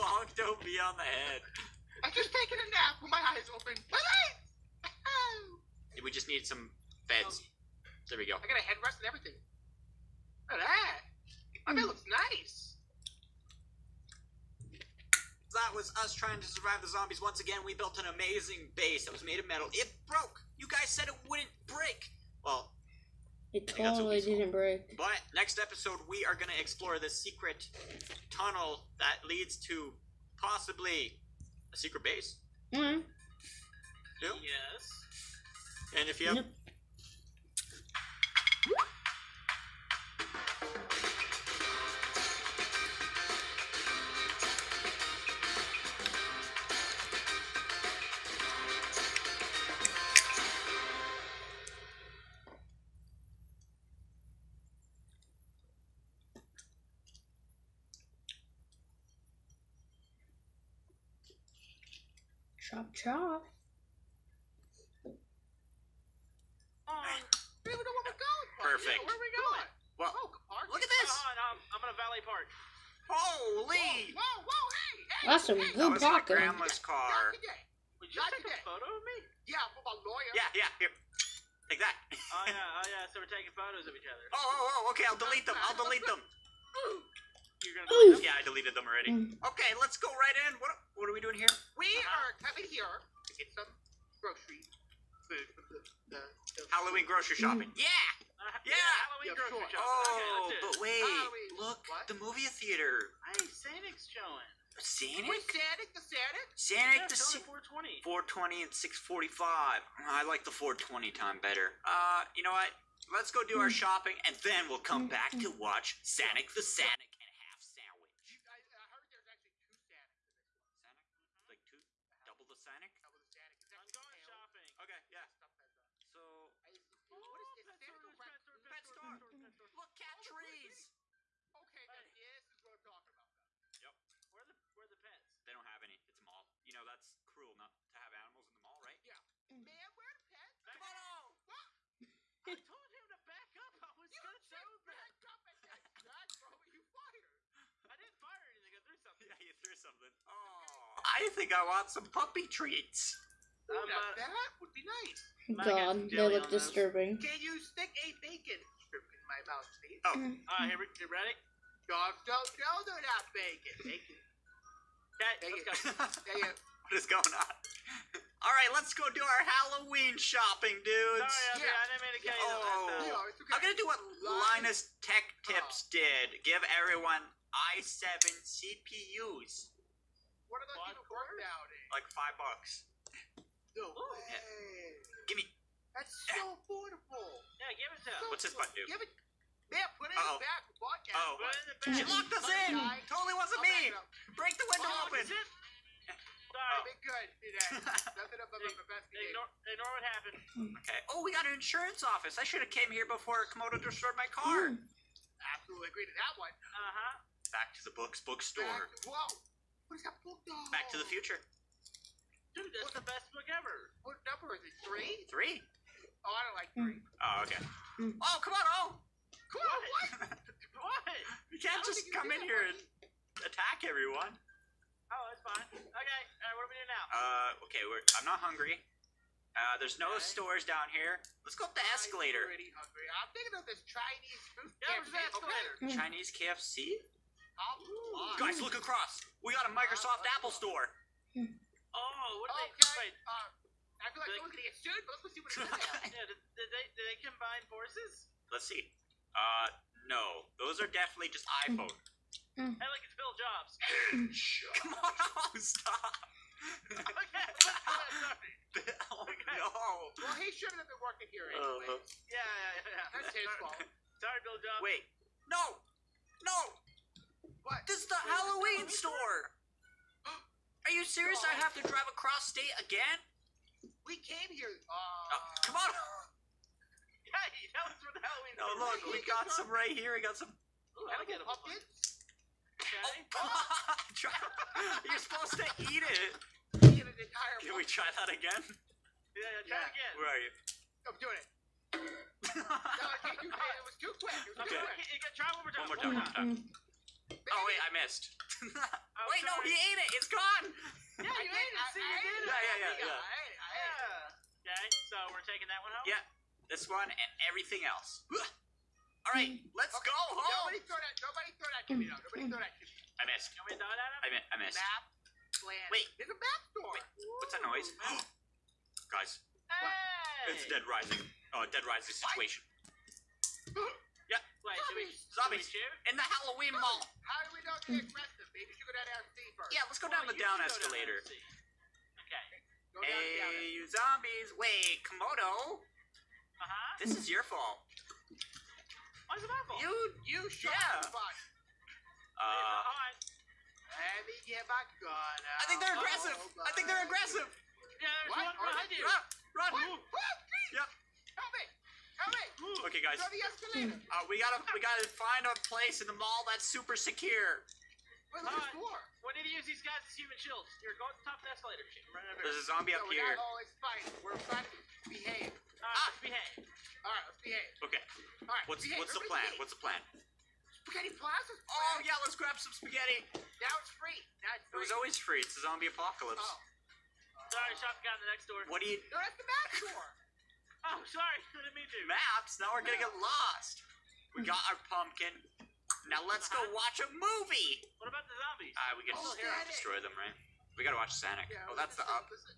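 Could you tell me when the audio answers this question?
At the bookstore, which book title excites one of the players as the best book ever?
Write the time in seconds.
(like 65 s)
210 s.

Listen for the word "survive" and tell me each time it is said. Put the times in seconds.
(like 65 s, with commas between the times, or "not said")
16 s.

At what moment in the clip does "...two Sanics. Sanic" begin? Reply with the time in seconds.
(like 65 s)
119 s.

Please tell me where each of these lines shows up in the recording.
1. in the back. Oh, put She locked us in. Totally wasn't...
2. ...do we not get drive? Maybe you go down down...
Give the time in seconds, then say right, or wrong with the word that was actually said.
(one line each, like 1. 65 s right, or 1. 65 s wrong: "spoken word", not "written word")
1. 190 s right
2. 327 s wrong: "aggressive", not "drive".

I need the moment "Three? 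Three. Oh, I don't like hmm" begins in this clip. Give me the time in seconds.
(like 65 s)
214 s.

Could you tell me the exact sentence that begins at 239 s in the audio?
We got a uh, Microsoft uh, Apple store.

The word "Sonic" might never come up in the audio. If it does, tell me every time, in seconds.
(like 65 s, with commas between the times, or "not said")
391 s.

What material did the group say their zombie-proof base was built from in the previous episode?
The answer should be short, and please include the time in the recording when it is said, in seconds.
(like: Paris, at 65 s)
metal, at 19 s.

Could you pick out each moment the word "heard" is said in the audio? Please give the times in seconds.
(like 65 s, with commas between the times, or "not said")
118 s.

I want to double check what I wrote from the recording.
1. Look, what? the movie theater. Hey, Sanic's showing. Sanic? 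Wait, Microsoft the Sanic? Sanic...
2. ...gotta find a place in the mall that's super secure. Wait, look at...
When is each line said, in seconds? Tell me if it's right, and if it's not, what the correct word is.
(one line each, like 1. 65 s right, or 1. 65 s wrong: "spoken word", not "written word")
1. 101 s wrong: "Sanic", not "Microsoft"
2. 354 s right.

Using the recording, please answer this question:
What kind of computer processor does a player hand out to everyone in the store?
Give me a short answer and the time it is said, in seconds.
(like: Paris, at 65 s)
i7 CPUs, at 177 s.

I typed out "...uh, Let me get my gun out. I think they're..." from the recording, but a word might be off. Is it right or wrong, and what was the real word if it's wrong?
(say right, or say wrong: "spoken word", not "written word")
right.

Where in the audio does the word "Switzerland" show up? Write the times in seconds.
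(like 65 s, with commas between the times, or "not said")
not said.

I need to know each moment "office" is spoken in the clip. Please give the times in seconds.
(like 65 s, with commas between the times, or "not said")
202 s.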